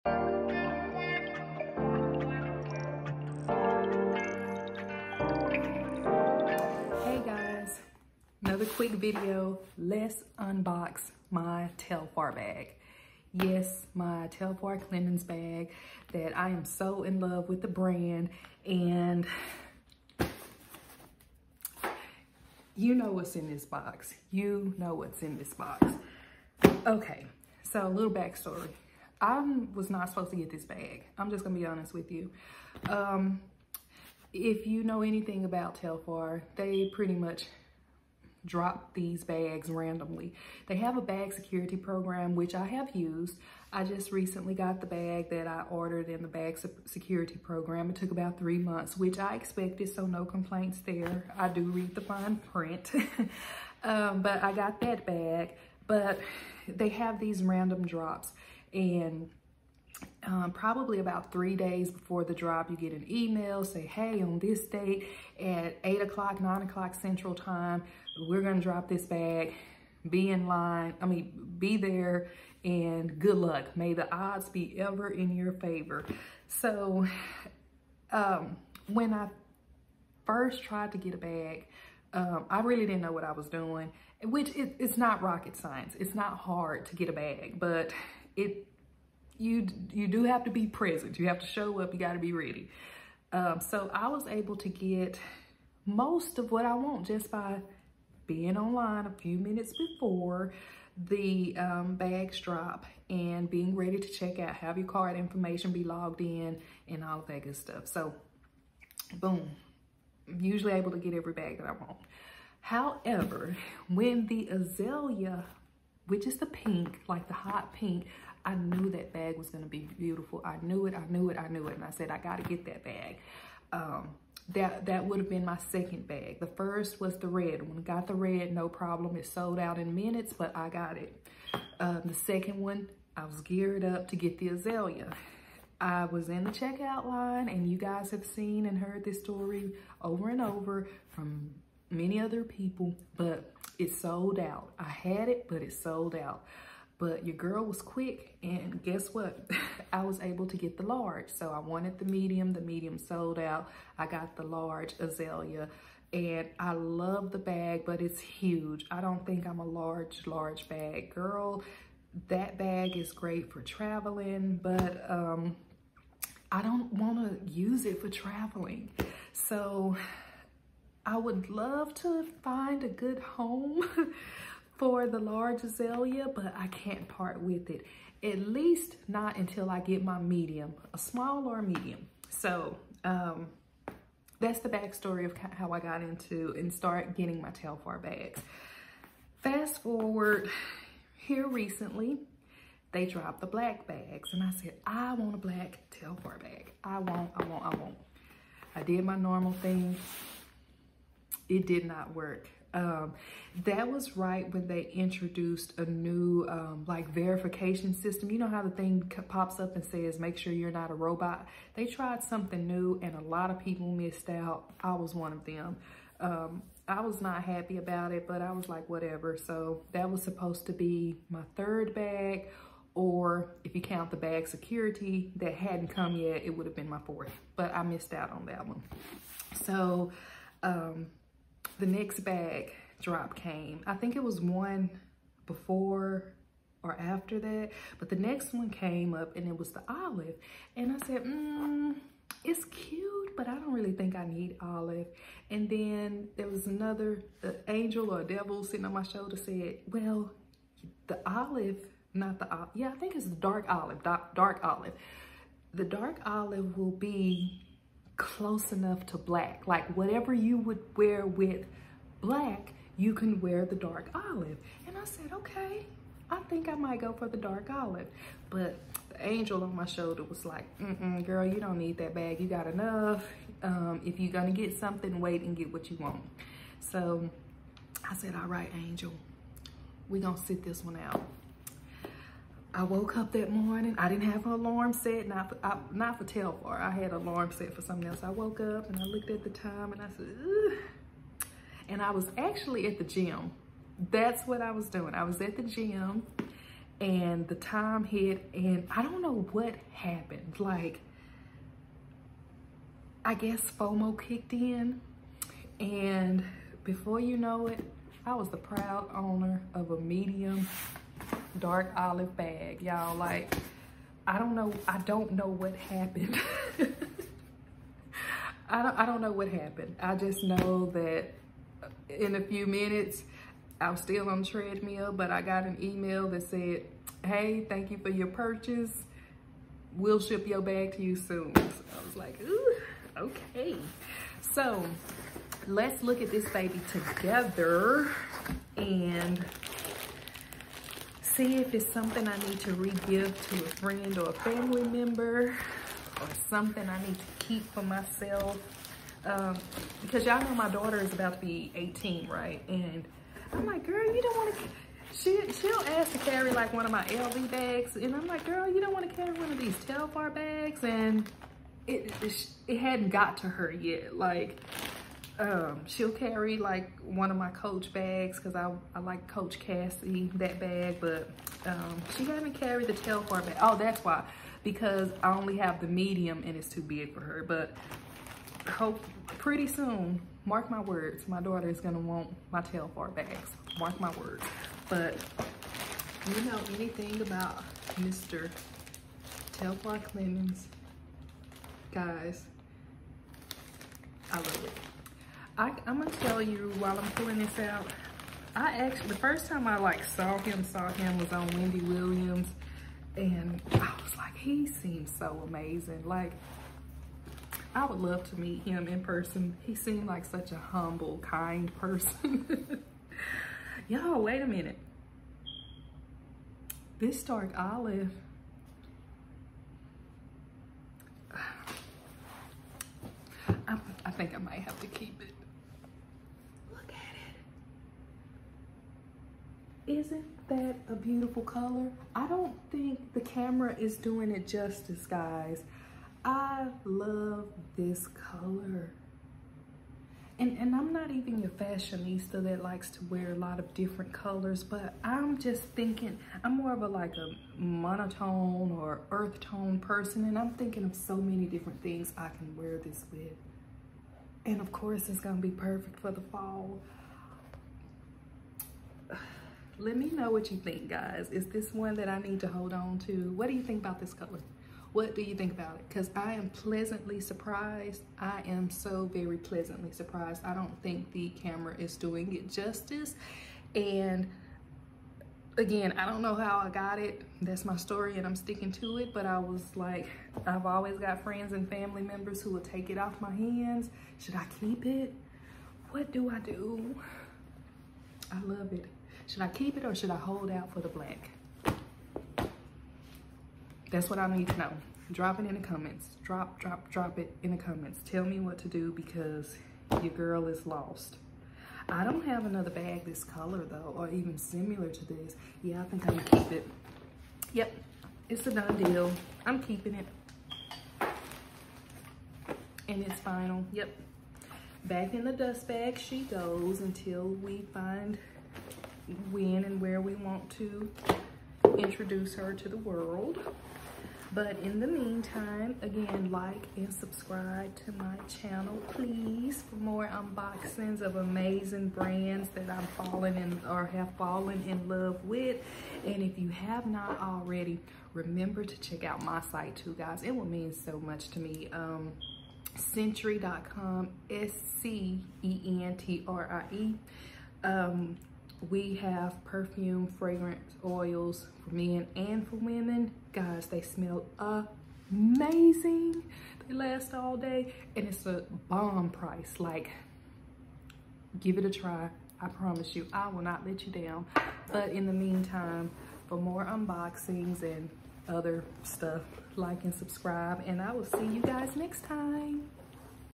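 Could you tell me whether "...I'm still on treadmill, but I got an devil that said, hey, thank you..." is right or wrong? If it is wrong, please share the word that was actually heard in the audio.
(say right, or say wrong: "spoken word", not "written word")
wrong: "email", not "devil".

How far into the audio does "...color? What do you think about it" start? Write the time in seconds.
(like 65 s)
464 s.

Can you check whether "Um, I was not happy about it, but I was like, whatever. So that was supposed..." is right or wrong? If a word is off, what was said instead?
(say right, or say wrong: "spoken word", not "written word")
right.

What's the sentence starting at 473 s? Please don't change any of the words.
And again, I don't know how I got it.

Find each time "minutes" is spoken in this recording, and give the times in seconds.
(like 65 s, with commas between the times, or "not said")
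99 s, 129 s, 322 s, 414 s.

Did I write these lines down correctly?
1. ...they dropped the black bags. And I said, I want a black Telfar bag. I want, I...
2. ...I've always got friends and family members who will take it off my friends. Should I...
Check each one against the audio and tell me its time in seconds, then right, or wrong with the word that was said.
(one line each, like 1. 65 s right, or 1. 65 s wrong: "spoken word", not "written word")
1. 192 s right
2. 480 s wrong: "hands", not "friends".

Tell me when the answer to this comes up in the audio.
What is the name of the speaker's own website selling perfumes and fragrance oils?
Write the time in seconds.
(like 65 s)
542 s.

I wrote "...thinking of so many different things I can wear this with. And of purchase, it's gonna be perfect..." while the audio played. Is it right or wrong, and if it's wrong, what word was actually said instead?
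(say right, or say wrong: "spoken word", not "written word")
wrong: "course", not "purchase".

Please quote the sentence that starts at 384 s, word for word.
But you know anything about Mr.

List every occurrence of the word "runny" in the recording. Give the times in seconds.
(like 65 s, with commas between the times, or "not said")
not said.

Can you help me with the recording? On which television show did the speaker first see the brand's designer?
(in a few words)
Wendy Williams.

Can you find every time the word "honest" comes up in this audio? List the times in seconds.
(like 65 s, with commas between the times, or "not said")
31 s.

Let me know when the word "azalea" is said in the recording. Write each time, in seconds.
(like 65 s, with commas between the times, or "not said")
114 s, 134 s, 154 s, 175 s.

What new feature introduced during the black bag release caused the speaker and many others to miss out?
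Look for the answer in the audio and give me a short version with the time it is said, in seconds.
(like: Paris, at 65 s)
Verification system, at 207 s.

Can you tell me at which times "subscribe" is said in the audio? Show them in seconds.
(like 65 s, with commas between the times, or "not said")
526 s, 569 s.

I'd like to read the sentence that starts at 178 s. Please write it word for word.
At least not until I get my medium, a small or a medium.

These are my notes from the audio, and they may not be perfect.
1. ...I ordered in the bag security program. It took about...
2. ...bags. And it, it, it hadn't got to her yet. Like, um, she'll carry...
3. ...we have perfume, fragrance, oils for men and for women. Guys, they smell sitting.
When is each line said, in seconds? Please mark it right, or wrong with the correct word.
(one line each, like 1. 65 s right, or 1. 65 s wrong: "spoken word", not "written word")
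1. 45 s right
2. 360 s right
3. 548 s wrong: "amazing", not "sitting".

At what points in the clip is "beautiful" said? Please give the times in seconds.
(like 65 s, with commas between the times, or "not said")
119 s, 430 s.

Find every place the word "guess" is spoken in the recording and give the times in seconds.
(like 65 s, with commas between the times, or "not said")
148 s, 303 s.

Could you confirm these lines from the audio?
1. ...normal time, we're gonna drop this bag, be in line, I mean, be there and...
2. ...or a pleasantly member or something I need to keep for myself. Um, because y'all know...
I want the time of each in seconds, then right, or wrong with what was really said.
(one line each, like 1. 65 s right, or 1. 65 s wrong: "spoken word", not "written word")
1. 66 s wrong: "central", not "normal"
2. 344 s wrong: "family", not "pleasantly".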